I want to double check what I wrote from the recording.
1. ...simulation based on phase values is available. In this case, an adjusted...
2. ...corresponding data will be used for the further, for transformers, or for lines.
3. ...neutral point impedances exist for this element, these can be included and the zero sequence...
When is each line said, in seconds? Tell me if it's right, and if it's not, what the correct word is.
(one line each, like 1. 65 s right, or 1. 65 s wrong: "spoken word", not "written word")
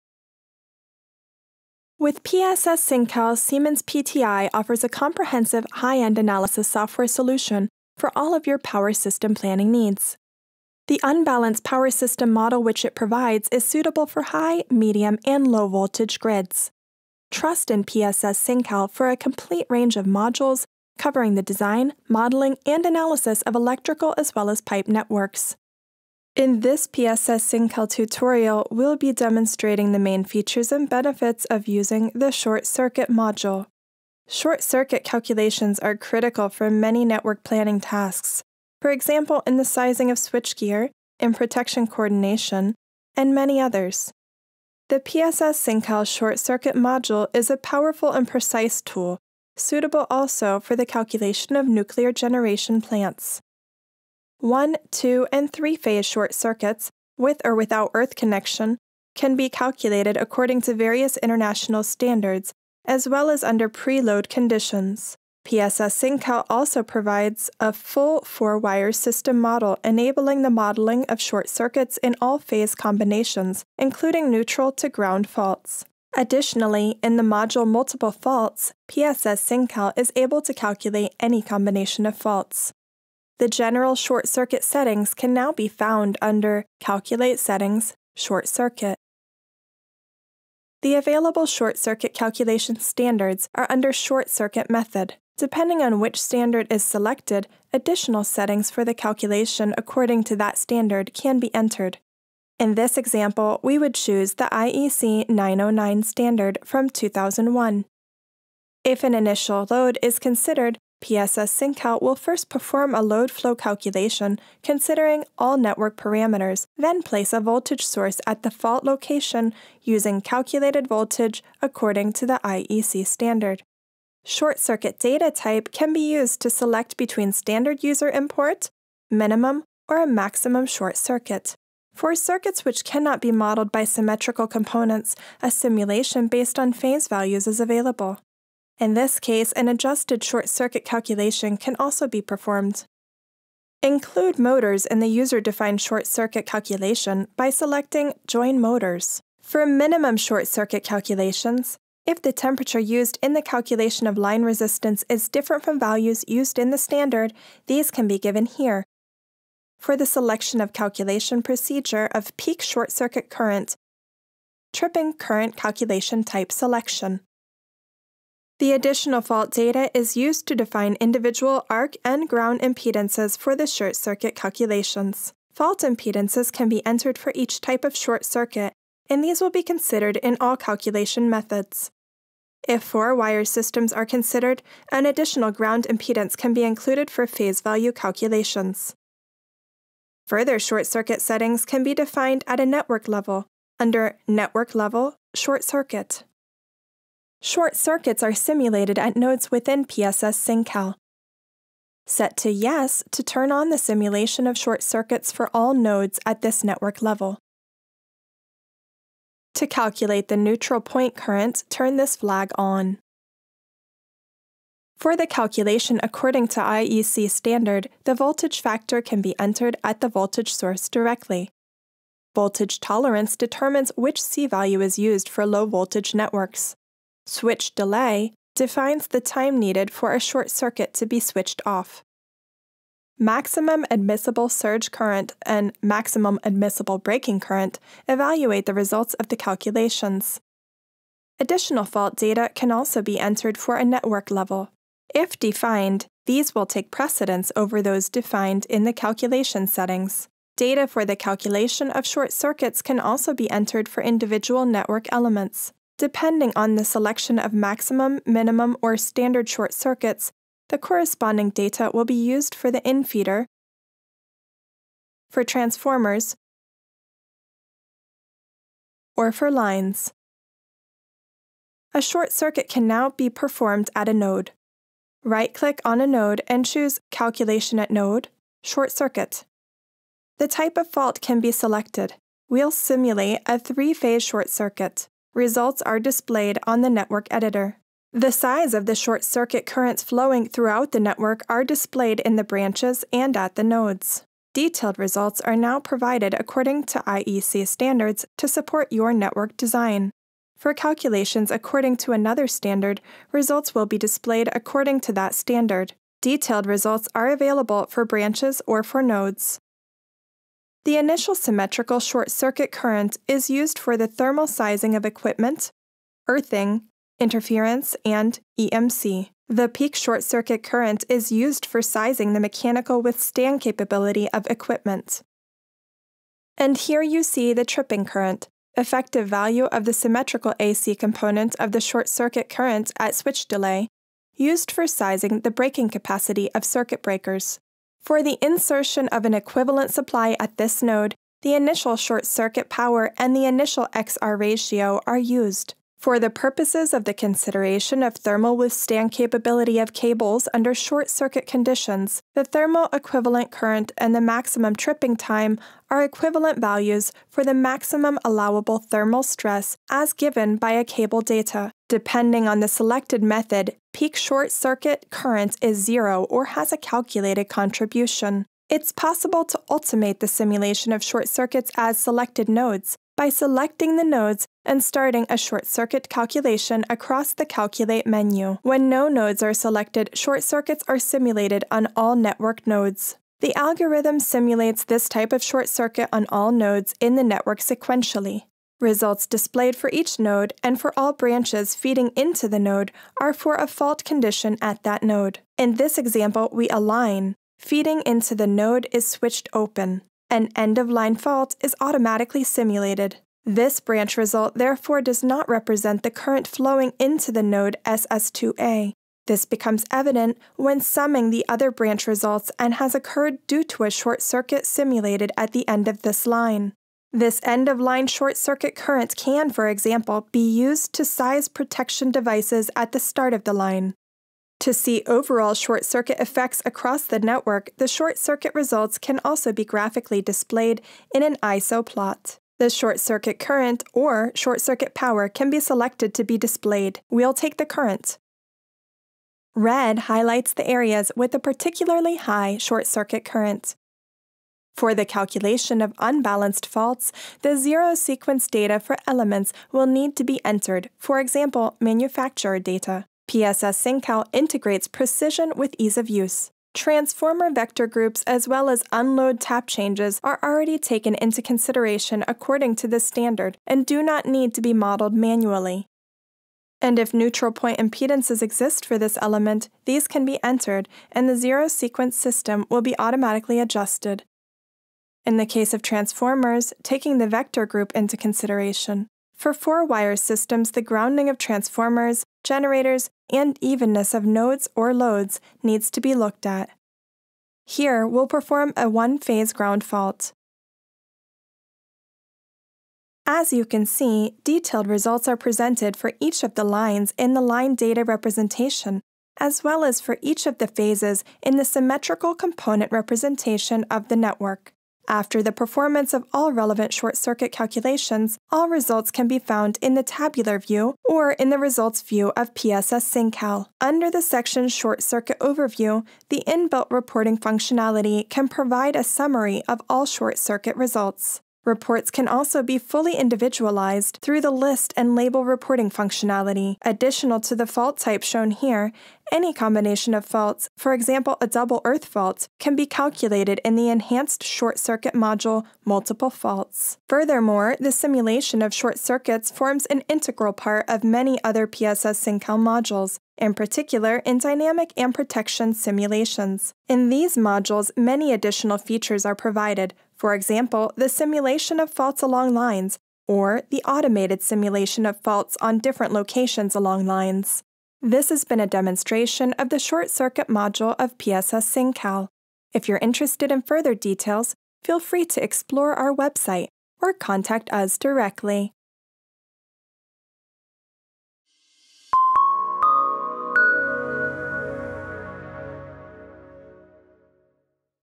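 1. 135 s right
2. 260 s wrong: "infeeder", not "further"
3. 467 s wrong: "entered", not "included".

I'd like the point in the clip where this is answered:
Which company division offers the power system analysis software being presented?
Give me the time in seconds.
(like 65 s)
3 s.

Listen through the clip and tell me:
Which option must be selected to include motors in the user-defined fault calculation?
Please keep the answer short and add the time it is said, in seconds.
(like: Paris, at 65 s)
Join Motors, at 148 s.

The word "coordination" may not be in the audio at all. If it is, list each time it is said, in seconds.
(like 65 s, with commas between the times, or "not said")
41 s.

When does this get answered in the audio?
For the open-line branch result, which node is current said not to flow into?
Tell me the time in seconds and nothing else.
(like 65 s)
407 s.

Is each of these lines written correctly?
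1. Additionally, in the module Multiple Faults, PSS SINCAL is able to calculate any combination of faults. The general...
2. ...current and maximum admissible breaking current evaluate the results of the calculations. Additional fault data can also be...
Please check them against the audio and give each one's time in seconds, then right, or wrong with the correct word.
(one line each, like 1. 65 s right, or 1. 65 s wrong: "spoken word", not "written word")
1. 76 s right
2. 234 s right.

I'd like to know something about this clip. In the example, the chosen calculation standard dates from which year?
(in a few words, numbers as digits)
2001.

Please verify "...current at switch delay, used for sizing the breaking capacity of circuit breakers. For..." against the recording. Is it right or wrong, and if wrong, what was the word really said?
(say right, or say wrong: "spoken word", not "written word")
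right.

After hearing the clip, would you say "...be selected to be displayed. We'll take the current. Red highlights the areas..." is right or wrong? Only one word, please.
right.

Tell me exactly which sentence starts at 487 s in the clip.
Here, we'll perform a one-phase ground fault.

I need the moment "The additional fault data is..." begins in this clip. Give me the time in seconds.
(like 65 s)
168 s.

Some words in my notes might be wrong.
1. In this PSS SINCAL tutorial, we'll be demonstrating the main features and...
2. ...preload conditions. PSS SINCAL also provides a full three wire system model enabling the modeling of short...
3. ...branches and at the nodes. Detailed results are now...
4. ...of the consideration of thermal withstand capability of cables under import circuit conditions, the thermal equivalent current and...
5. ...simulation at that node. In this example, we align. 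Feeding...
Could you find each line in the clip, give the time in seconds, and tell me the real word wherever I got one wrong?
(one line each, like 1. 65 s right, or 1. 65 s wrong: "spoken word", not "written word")
1. 26 s right
2. 63 s wrong: "four", not "three"
3. 292 s right
4. 346 s wrong: "short", not "import"
5. 394 s wrong: "condition", not "simulation".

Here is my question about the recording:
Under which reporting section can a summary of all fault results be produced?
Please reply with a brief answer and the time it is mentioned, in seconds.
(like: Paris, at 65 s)
Short Circuit Overview, at 514 s.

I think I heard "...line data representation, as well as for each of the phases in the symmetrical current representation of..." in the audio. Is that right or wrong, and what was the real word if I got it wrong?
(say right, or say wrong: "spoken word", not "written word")
wrong: "component", not "current".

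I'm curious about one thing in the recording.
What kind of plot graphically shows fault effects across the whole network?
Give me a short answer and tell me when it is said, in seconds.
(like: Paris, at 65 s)
ISO plot, at 431 s.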